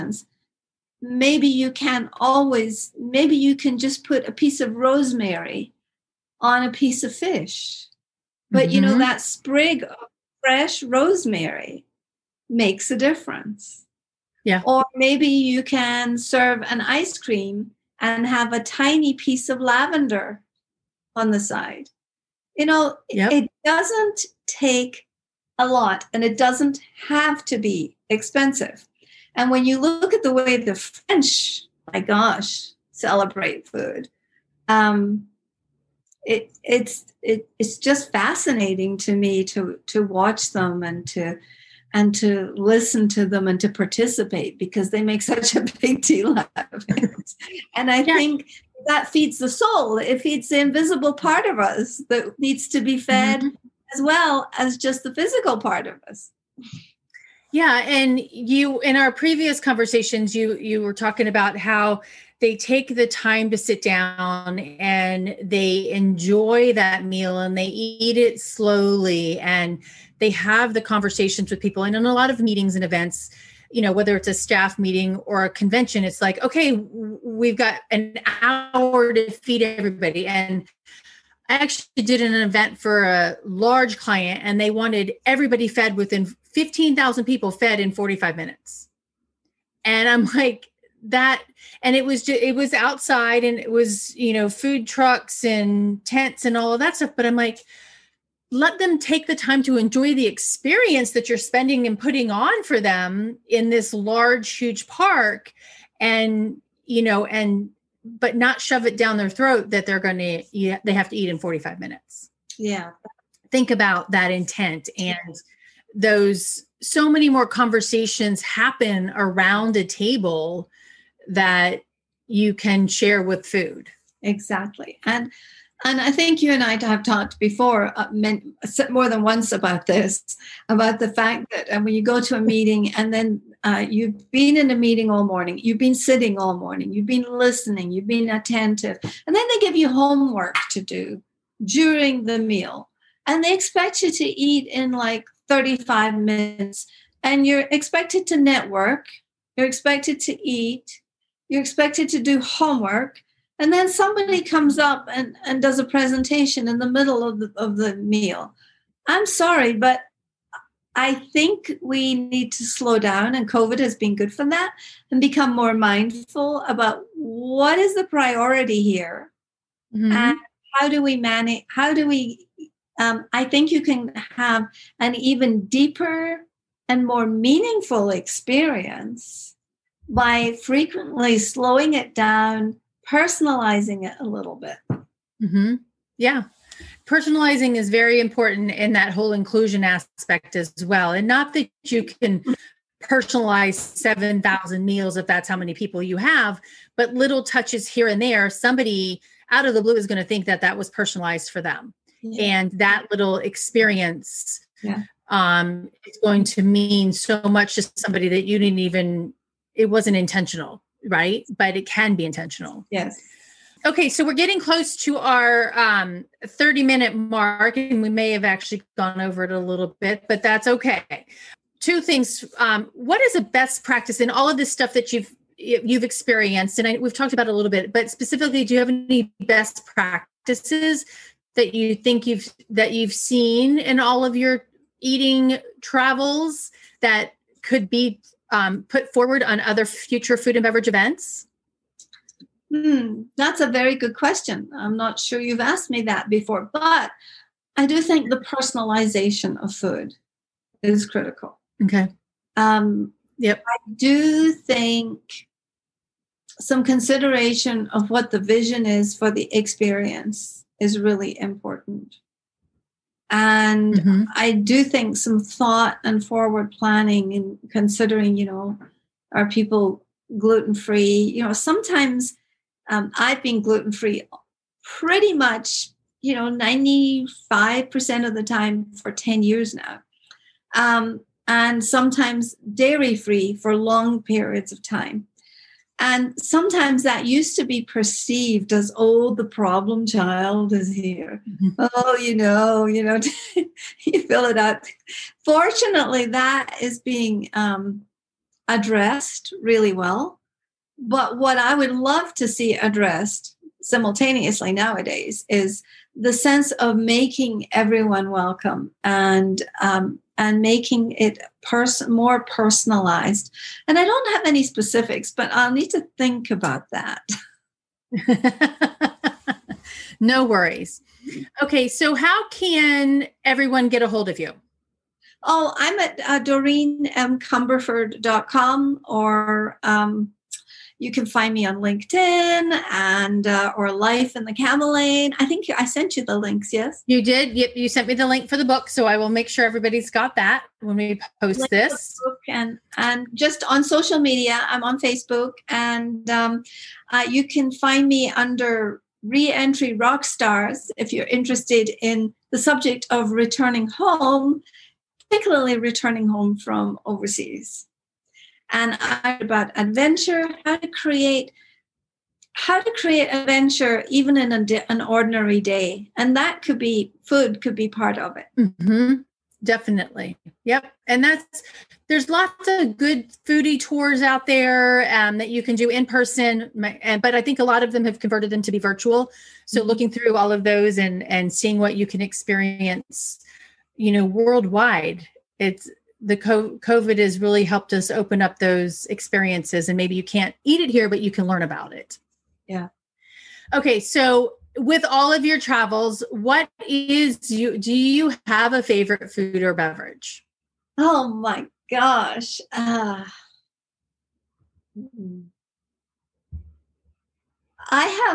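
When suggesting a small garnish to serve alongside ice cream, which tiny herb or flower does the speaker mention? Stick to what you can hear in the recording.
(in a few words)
Lavender.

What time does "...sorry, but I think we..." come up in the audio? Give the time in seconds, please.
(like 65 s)
159 s.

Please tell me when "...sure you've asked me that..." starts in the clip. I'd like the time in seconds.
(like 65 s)
245 s.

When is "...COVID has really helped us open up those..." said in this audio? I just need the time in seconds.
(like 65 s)
386 s.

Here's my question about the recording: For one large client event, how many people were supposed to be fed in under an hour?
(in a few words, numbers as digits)
15,000.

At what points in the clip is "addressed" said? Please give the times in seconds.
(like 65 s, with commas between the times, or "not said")
298 s, 302 s.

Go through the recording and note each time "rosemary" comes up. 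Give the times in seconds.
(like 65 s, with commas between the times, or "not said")
4 s, 10 s.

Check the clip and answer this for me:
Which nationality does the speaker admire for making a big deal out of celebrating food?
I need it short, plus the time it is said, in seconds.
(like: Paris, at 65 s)
The French, at 30 s.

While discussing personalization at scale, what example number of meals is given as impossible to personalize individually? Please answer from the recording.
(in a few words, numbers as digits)
7,000.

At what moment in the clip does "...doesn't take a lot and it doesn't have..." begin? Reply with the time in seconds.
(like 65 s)
23 s.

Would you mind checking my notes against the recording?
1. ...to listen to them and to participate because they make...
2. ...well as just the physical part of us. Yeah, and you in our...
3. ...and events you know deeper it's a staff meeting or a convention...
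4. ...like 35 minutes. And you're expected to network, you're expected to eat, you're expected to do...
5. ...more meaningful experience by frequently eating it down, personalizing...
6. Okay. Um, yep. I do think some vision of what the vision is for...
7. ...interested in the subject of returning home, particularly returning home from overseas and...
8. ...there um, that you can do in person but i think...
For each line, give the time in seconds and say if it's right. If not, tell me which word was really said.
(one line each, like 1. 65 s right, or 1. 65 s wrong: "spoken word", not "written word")
1. 42 s right
2. 54 s right
3. 72 s wrong: "whether", not "deeper"
4. 144 s right
5. 177 s wrong: "slowing", not "eating"
6. 251 s wrong: "consideration", not "vision"
7. 351 s right
8. 374 s right.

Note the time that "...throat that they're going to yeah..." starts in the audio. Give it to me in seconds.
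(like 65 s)
109 s.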